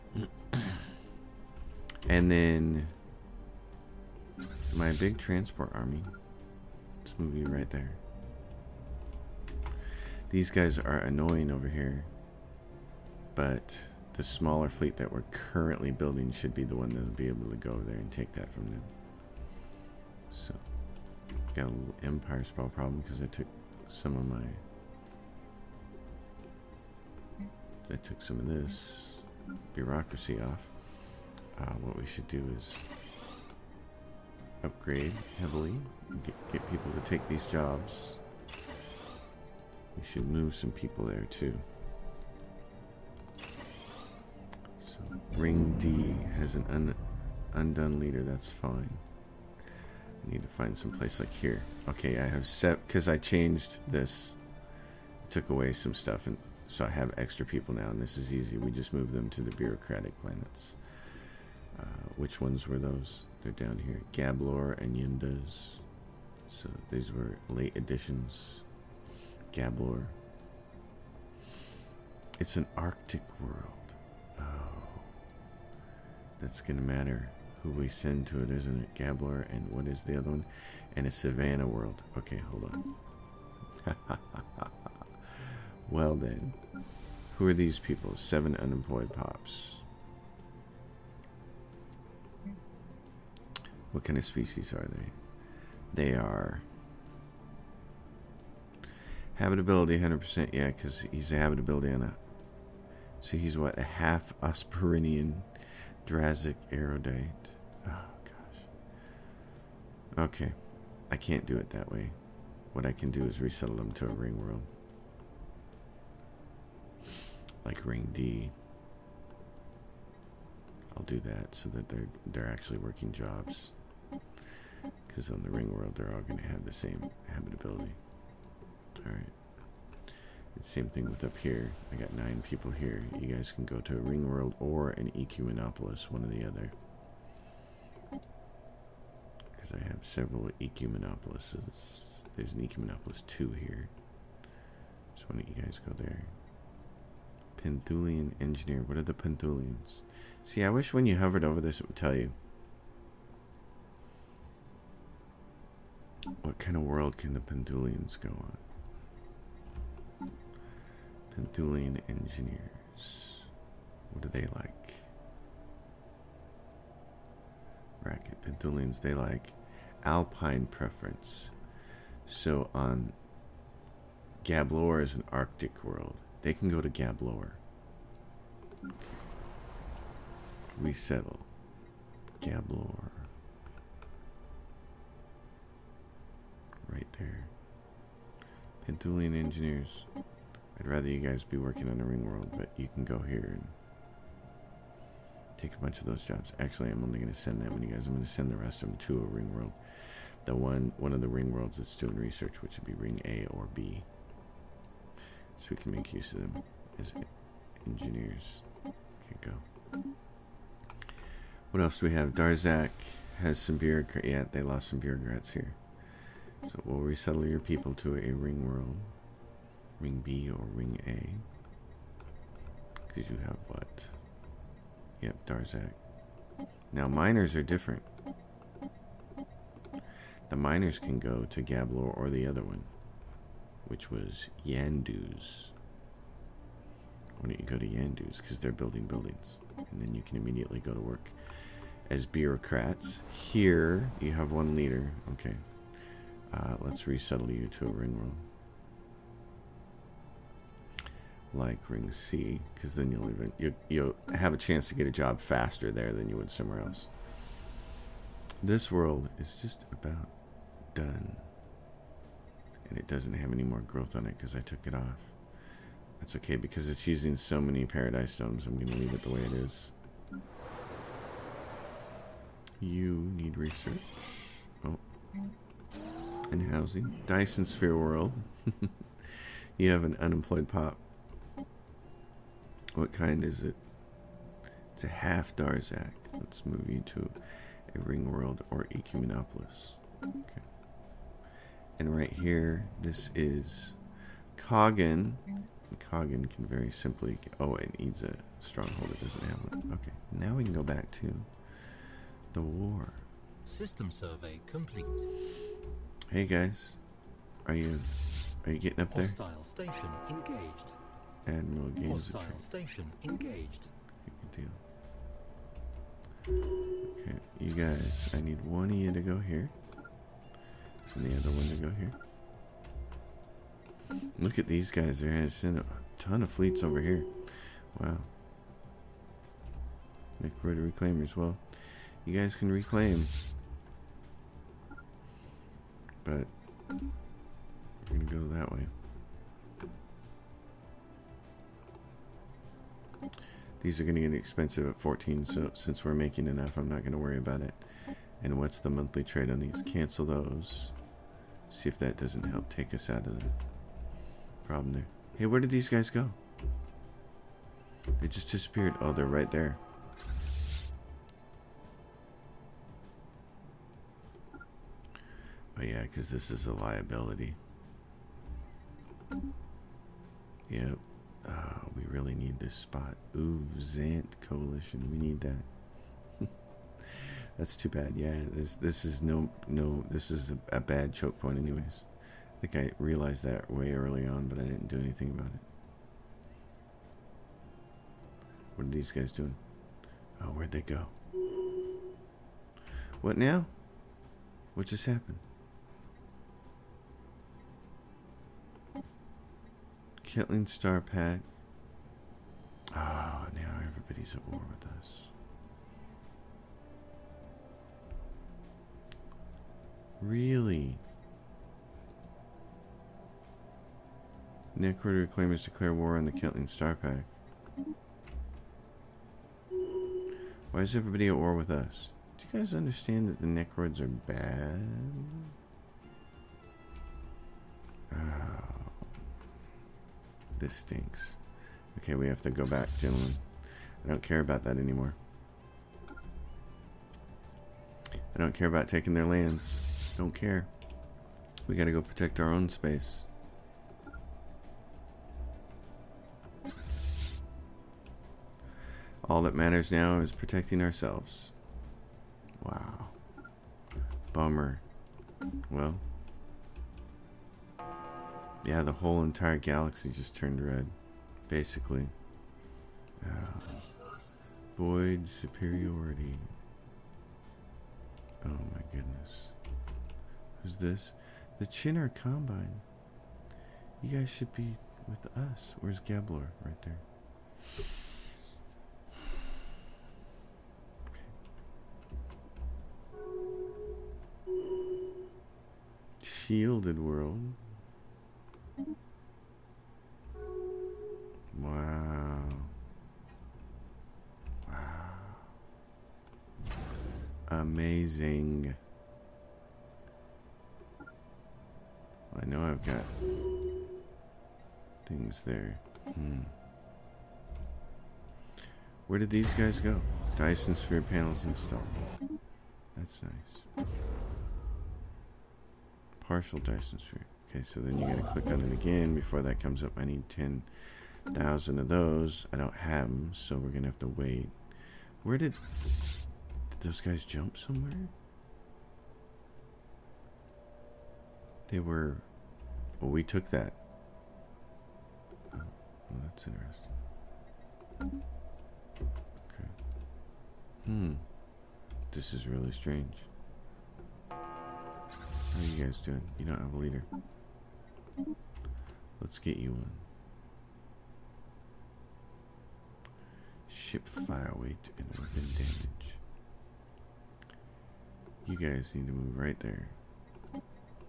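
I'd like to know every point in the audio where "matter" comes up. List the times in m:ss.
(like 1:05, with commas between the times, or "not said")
1:16, 7:29.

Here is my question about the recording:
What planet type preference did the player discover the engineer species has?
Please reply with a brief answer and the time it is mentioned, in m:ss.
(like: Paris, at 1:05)
Alpine, at 2:50.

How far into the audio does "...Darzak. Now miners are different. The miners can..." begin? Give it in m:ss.
3:45.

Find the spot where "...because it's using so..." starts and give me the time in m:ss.
4:26.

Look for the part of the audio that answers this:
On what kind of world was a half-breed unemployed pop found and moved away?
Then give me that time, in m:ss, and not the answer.
4:37.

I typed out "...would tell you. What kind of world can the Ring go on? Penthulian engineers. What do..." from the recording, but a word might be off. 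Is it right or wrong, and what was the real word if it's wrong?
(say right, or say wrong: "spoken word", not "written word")
wrong: "Penthulians", not "Ring".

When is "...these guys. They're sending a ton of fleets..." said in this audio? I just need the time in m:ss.
5:24.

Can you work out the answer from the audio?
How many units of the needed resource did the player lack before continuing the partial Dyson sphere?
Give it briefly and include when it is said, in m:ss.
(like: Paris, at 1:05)
10,000, at 8:40.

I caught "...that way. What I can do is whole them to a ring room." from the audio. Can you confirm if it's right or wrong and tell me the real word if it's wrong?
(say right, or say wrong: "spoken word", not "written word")
wrong: "resettle", not "whole".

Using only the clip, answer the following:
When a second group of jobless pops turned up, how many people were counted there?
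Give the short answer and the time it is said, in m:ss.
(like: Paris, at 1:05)
9, at 2:12.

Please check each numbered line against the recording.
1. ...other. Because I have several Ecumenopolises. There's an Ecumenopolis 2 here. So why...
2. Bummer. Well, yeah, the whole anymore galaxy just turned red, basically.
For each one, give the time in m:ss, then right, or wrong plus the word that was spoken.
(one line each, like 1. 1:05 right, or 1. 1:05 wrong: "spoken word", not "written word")
1. 2:16 right
2. 7:34 wrong: "entire", not "anymore".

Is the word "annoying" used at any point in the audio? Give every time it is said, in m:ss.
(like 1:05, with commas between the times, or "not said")
0:10.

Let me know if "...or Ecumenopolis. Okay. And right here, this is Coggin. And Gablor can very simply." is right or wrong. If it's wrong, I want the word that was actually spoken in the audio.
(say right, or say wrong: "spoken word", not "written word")
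wrong: "Coggin", not "Gablor".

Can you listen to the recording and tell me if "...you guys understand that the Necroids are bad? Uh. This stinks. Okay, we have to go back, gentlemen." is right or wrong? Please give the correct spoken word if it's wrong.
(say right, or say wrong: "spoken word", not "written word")
right.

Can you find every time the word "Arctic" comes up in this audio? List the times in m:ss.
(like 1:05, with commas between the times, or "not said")
1:12, 2:55.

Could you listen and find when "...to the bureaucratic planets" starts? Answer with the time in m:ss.
0:59.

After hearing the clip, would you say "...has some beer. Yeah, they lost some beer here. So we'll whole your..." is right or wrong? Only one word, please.
wrong.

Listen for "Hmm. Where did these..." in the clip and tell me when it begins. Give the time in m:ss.
8:26.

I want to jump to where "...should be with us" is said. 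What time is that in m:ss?
7:54.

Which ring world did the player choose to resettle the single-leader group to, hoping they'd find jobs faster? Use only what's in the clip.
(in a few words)
Ring C.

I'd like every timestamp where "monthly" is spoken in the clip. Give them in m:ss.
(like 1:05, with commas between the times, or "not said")
5:48.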